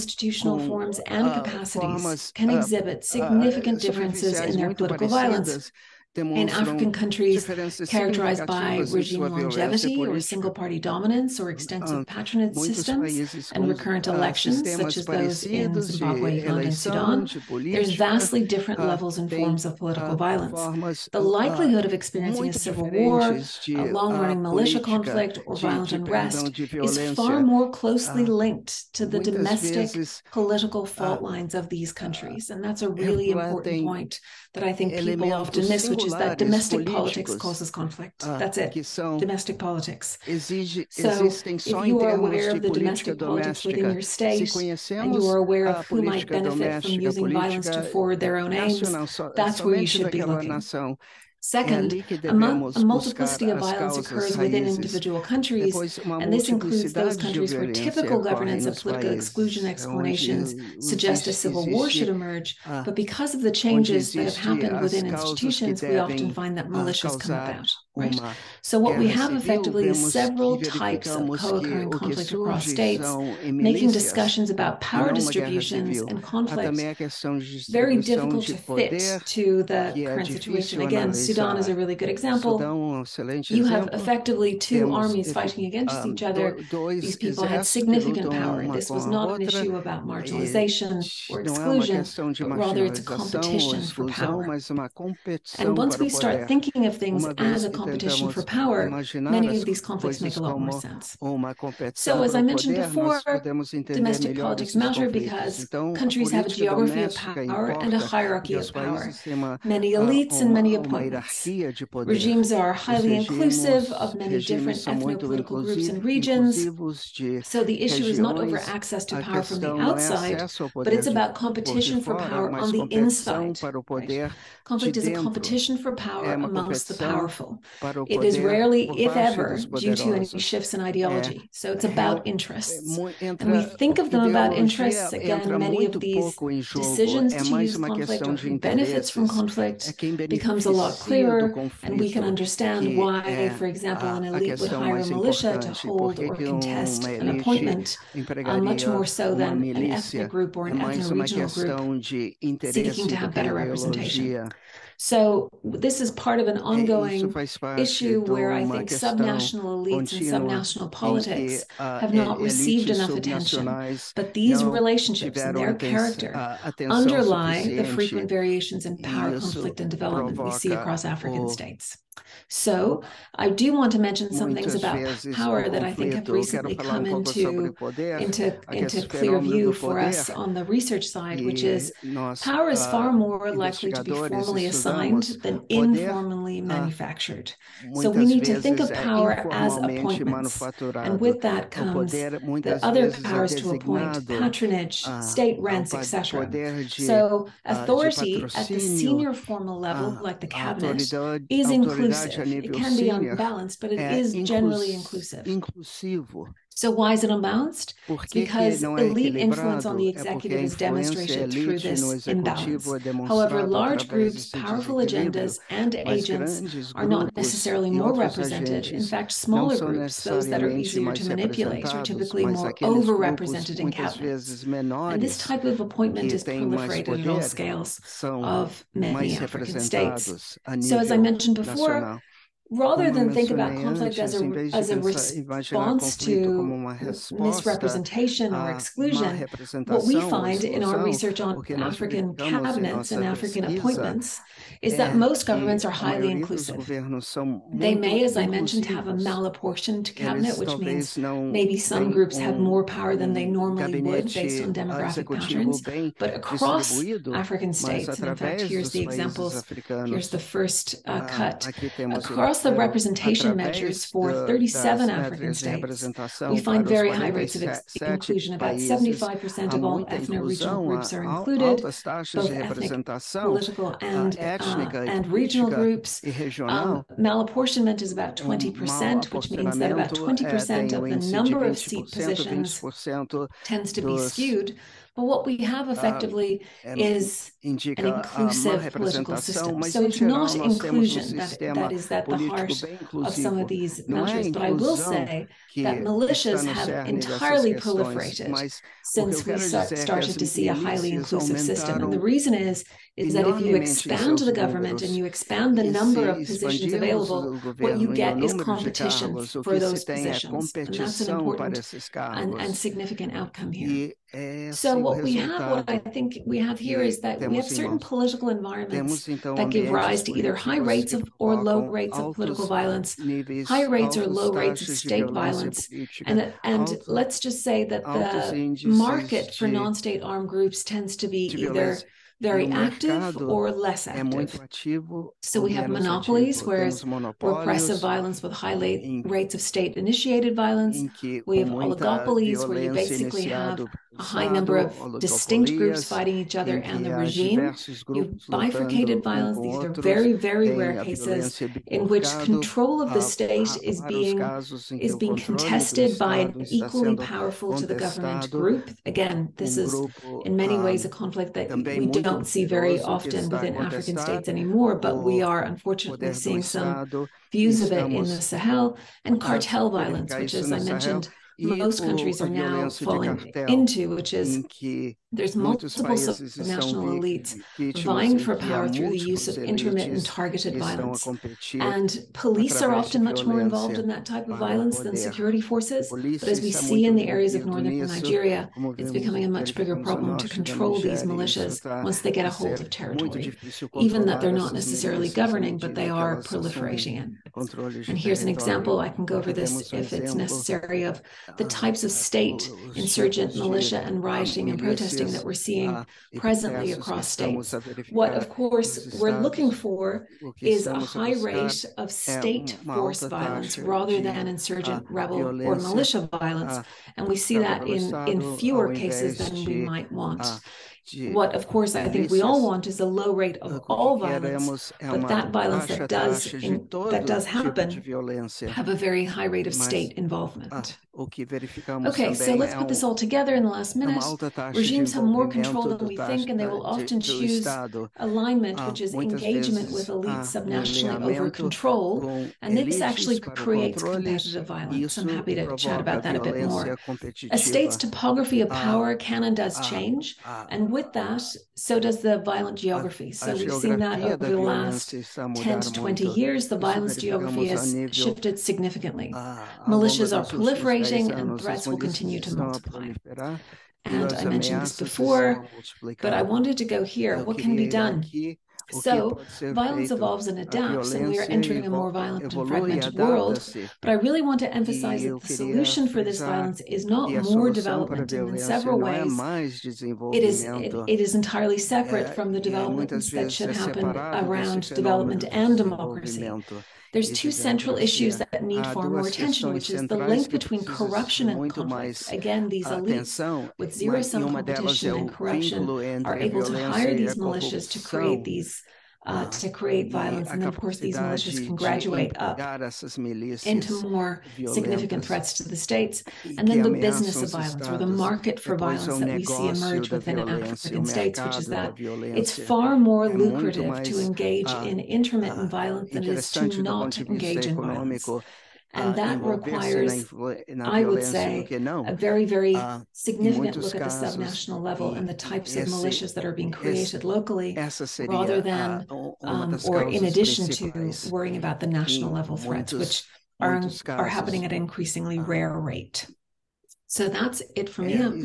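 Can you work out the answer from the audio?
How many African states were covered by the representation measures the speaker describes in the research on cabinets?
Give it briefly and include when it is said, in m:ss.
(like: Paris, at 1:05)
37, at 4:24.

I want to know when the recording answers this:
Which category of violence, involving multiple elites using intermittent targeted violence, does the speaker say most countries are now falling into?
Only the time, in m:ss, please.
6:09.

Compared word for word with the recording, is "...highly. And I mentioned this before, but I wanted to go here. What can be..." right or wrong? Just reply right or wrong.
wrong.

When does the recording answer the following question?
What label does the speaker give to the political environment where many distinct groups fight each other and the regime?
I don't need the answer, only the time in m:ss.
5:41.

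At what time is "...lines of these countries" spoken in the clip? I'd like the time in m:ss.
0:31.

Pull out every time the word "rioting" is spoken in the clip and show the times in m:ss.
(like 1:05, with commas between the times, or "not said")
6:44.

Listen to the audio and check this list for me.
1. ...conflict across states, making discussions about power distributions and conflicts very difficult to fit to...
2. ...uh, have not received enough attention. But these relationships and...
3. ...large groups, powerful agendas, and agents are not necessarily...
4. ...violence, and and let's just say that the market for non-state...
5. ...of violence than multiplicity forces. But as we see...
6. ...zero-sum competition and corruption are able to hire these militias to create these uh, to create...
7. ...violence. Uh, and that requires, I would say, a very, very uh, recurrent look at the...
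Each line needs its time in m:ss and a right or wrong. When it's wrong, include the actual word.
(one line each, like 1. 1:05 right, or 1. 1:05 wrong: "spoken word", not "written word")
1. 1:11 right
2. 2:41 right
3. 3:33 right
4. 5:25 right
5. 6:24 wrong: "security", not "multiplicity"
6. 8:13 right
7. 8:37 wrong: "significant", not "recurrent".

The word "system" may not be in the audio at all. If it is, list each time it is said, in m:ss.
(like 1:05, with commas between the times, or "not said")
0:12, 4:49, 5:01.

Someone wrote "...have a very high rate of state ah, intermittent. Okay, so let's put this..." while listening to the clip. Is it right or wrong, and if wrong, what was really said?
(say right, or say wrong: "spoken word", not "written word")
wrong: "involvement", not "intermittent".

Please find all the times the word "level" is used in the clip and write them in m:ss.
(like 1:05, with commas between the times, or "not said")
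0:18, 3:19, 8:44, 8:52.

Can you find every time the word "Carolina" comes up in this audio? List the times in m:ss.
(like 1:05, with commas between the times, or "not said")
not said.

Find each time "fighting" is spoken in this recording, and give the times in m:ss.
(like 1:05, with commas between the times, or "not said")
1:25, 5:46.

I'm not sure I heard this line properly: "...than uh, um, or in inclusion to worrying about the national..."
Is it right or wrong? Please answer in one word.
wrong.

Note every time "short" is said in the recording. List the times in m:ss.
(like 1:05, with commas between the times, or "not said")
not said.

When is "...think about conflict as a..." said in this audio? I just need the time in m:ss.
3:53.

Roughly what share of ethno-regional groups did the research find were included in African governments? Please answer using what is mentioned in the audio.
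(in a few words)
75%.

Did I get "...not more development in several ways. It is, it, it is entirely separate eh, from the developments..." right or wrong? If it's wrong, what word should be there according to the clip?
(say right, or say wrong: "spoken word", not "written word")
right.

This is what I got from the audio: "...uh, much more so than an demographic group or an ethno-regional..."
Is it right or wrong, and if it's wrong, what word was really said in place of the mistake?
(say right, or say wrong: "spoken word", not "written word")
wrong: "ethnic", not "demographic".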